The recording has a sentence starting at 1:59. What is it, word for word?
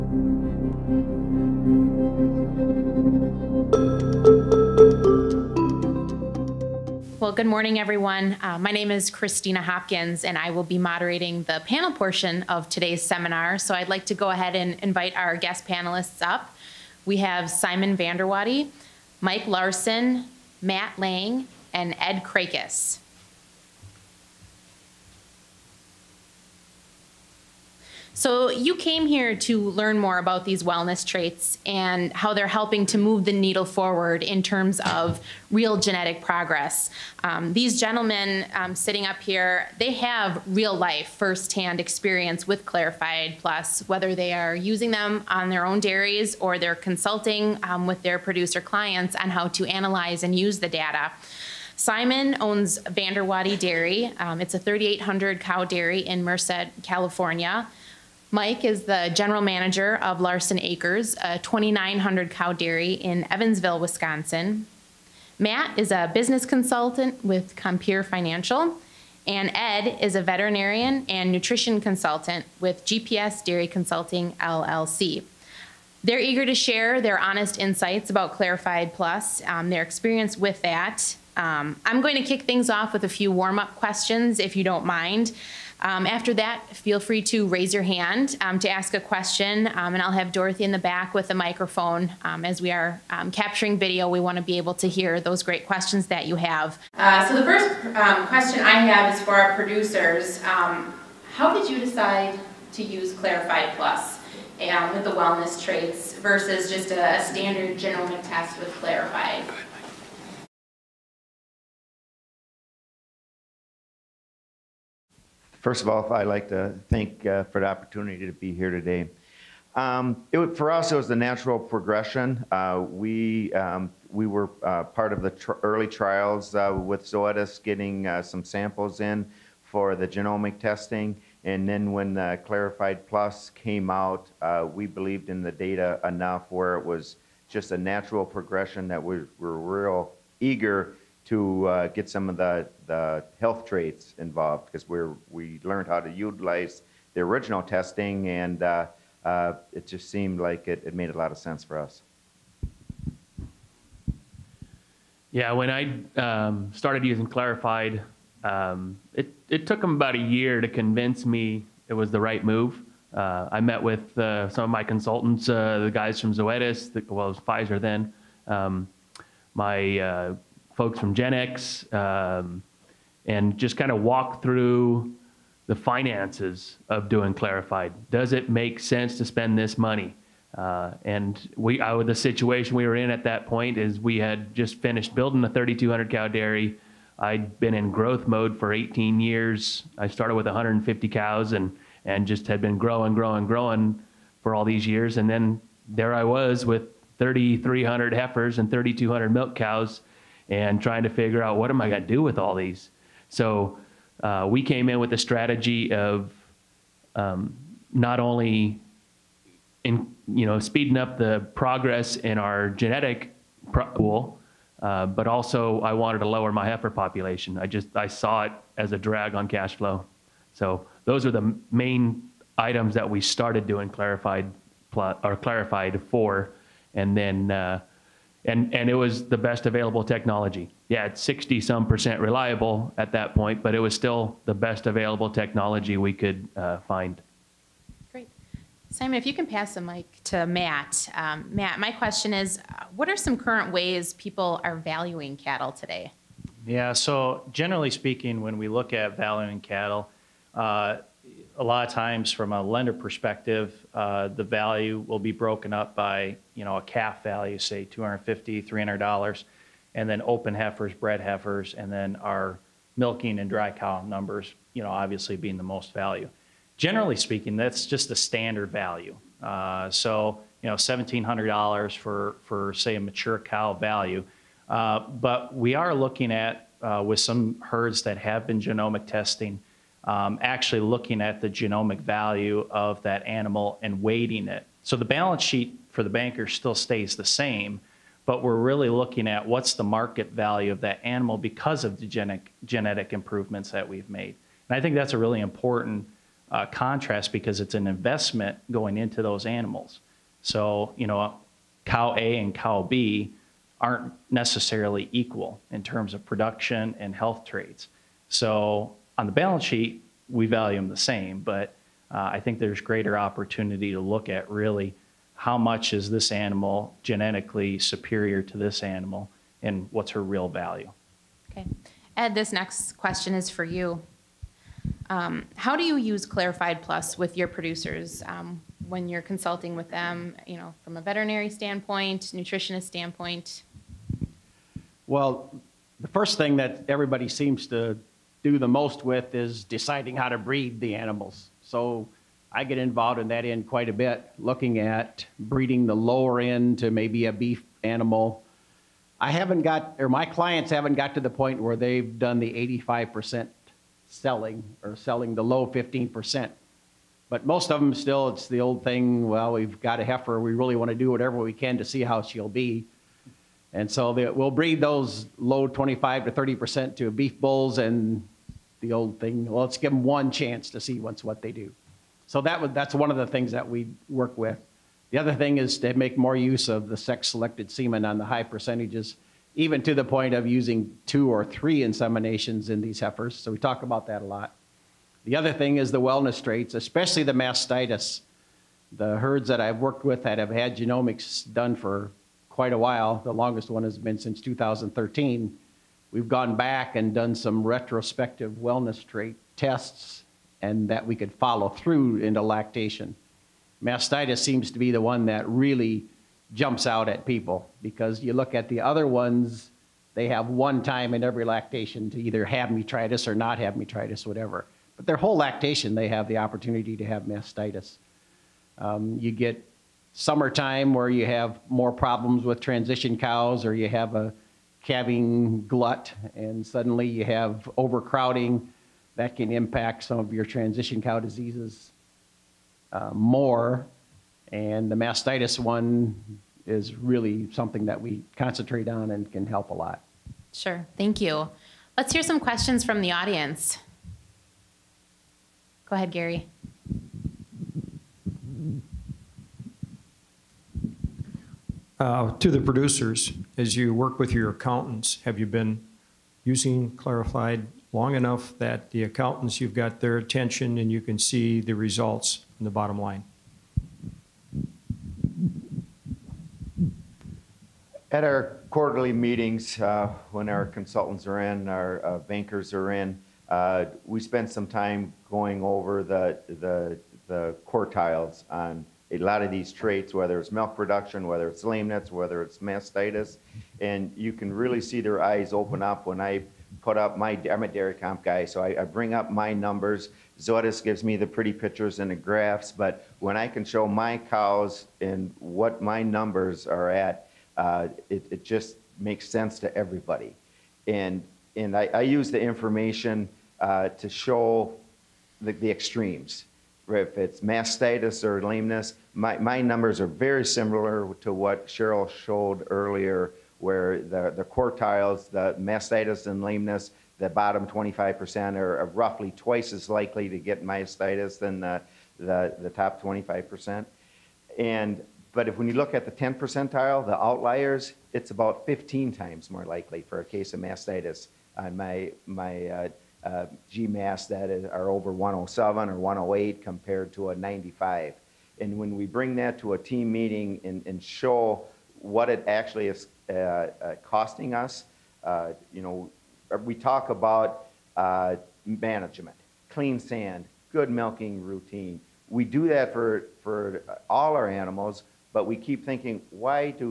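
Um, it, for us, it was the natural progression.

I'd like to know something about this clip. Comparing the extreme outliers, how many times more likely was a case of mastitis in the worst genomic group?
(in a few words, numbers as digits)
15.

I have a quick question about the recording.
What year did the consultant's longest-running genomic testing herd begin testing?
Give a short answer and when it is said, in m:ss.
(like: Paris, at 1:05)
2013, at 6:34.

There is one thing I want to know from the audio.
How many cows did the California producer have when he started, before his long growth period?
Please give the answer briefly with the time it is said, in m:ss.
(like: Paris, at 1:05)
150, at 3:10.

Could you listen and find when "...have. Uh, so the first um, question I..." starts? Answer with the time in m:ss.
1:36.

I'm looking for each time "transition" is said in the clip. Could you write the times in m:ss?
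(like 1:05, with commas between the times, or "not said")
7:02, 7:10.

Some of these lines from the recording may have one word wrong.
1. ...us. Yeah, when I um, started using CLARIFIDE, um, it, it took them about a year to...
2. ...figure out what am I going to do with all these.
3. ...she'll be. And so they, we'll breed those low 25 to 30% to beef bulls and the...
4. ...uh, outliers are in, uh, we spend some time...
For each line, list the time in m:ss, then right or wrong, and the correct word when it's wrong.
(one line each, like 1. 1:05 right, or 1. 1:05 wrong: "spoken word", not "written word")
1. 2:31 right
2. 3:21 right
3. 6:02 right
4. 7:52 wrong: "bankers", not "outliers".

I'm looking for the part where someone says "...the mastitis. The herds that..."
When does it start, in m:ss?
6:27.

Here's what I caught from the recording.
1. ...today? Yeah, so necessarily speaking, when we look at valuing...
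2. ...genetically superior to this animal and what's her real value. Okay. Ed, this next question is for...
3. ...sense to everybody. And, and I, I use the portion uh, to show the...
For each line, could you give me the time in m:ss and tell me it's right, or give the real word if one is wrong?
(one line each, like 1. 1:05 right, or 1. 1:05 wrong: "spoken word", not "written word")
1. 4:05 wrong: "generally", not "necessarily"
2. 5:17 right
3. 8:19 wrong: "information", not "portion".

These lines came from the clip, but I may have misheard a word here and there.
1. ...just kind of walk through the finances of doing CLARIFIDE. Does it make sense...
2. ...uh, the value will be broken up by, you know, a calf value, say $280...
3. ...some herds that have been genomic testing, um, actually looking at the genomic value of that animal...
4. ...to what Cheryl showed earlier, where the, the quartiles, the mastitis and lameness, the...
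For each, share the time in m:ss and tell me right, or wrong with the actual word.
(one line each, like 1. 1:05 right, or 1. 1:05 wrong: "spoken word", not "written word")
1. 2:53 right
2. 4:13 wrong: "250", not "280"
3. 4:37 right
4. 8:31 right.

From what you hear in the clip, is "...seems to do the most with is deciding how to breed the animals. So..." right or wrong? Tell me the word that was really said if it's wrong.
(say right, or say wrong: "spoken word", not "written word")
right.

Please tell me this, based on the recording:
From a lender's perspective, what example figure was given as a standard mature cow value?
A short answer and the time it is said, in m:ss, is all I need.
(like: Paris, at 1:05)
$1,700, at 4:30.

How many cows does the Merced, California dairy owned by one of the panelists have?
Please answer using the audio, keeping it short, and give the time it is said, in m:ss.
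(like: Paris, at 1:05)
3,800, at 0:54.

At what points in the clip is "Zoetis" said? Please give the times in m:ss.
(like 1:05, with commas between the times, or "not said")
2:07, 2:46, 8:10.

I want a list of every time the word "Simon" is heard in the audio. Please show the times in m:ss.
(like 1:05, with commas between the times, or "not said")
0:17, 0:51, 3:58.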